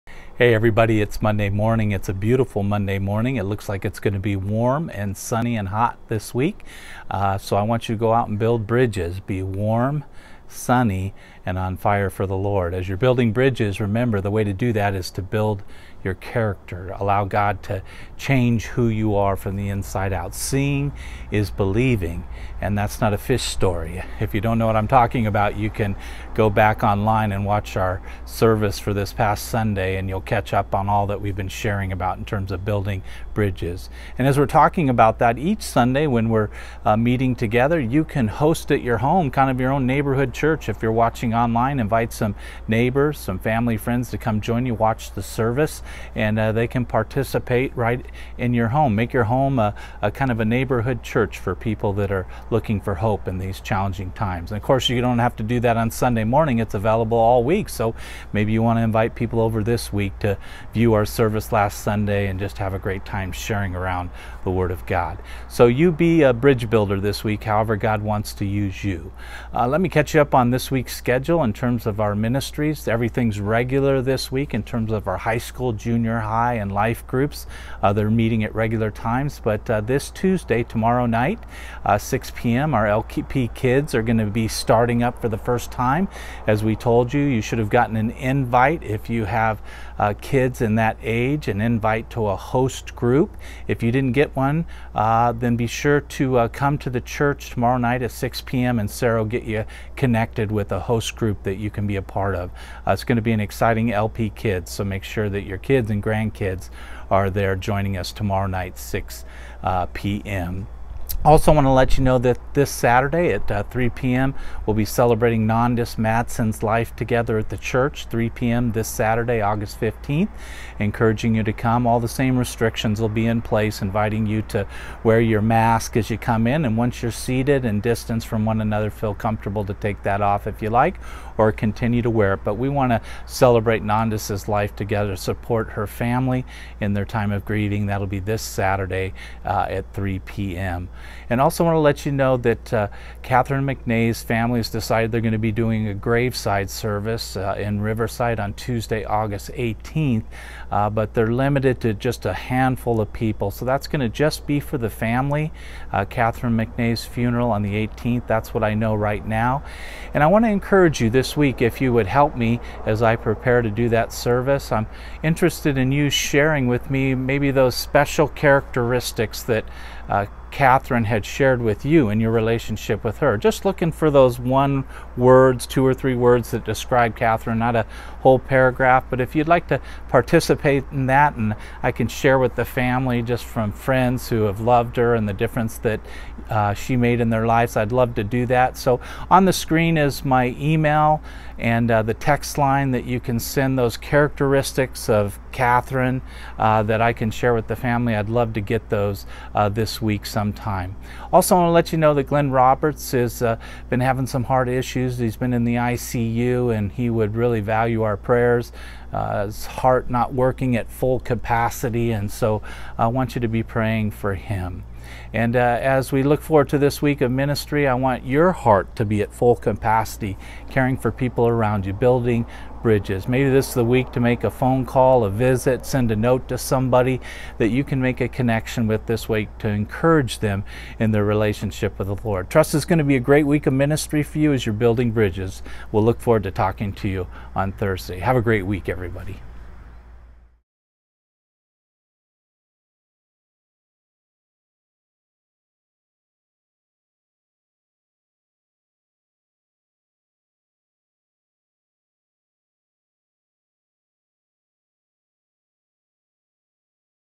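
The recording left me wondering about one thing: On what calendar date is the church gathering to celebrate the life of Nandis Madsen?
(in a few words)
August 15.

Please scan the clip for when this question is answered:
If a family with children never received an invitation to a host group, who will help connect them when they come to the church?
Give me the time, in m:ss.
1:38.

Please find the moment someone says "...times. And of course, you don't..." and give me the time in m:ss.
0:54.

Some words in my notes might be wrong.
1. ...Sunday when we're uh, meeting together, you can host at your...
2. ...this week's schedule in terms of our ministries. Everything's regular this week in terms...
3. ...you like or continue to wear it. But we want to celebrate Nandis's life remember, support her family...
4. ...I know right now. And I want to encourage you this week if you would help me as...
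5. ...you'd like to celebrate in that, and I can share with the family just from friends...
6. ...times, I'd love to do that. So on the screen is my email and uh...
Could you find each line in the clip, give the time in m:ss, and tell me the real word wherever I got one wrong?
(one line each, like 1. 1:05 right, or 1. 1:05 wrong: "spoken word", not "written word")
1. 0:35 right
2. 1:10 right
3. 2:10 wrong: "together", not "remember"
4. 2:38 right
5. 2:59 wrong: "participate", not "celebrate"
6. 3:07 wrong: "lives", not "times".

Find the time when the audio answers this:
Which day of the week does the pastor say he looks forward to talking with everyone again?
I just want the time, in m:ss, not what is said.
3:57.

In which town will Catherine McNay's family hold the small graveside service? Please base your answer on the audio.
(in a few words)
Riverside.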